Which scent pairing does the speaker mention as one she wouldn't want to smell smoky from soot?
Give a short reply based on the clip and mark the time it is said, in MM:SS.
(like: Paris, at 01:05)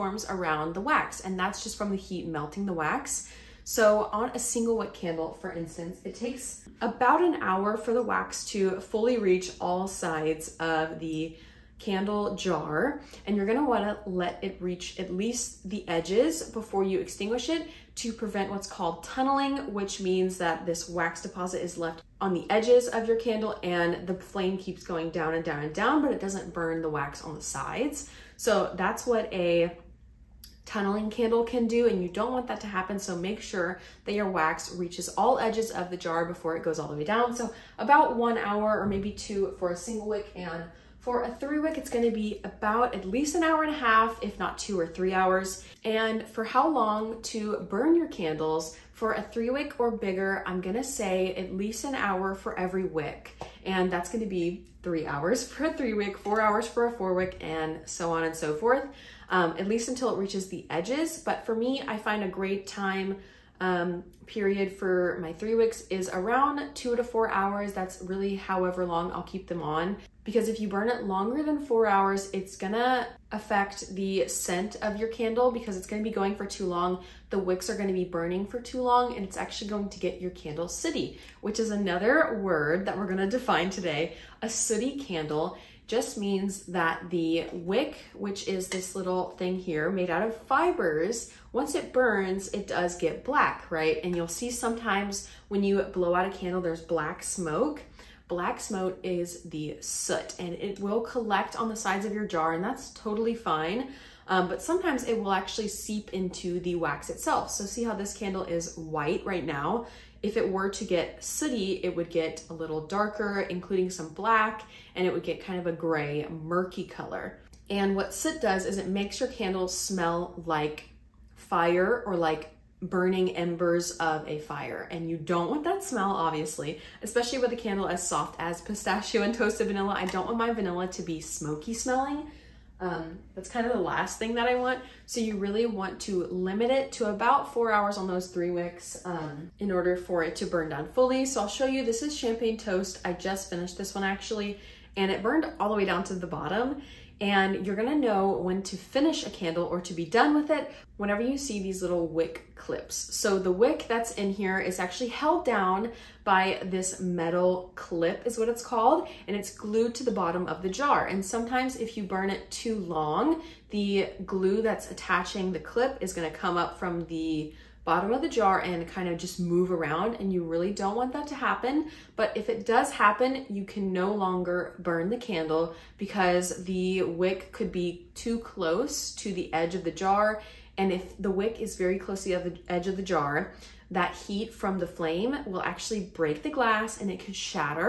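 Pistachio and toasted vanilla, at 02:08.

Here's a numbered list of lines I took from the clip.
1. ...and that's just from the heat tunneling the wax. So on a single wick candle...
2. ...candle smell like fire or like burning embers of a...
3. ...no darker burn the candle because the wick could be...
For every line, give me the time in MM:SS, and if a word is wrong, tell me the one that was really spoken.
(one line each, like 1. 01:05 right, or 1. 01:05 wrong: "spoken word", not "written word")
1. 00:01 wrong: "melting", not "tunneling"
2. 01:59 right
3. 02:53 wrong: "longer", not "darker".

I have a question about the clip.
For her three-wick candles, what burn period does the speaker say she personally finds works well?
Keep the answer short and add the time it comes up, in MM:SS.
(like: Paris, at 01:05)
2 to 4 hours, at 01:06.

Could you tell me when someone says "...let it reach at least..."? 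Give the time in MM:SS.
00:14.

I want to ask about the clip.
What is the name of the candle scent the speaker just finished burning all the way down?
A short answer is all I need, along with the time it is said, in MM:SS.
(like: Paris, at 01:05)
Champagne toast, at 02:22.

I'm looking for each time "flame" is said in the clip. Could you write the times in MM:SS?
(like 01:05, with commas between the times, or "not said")
00:24, 03:04.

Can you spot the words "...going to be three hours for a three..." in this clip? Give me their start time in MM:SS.
00:54.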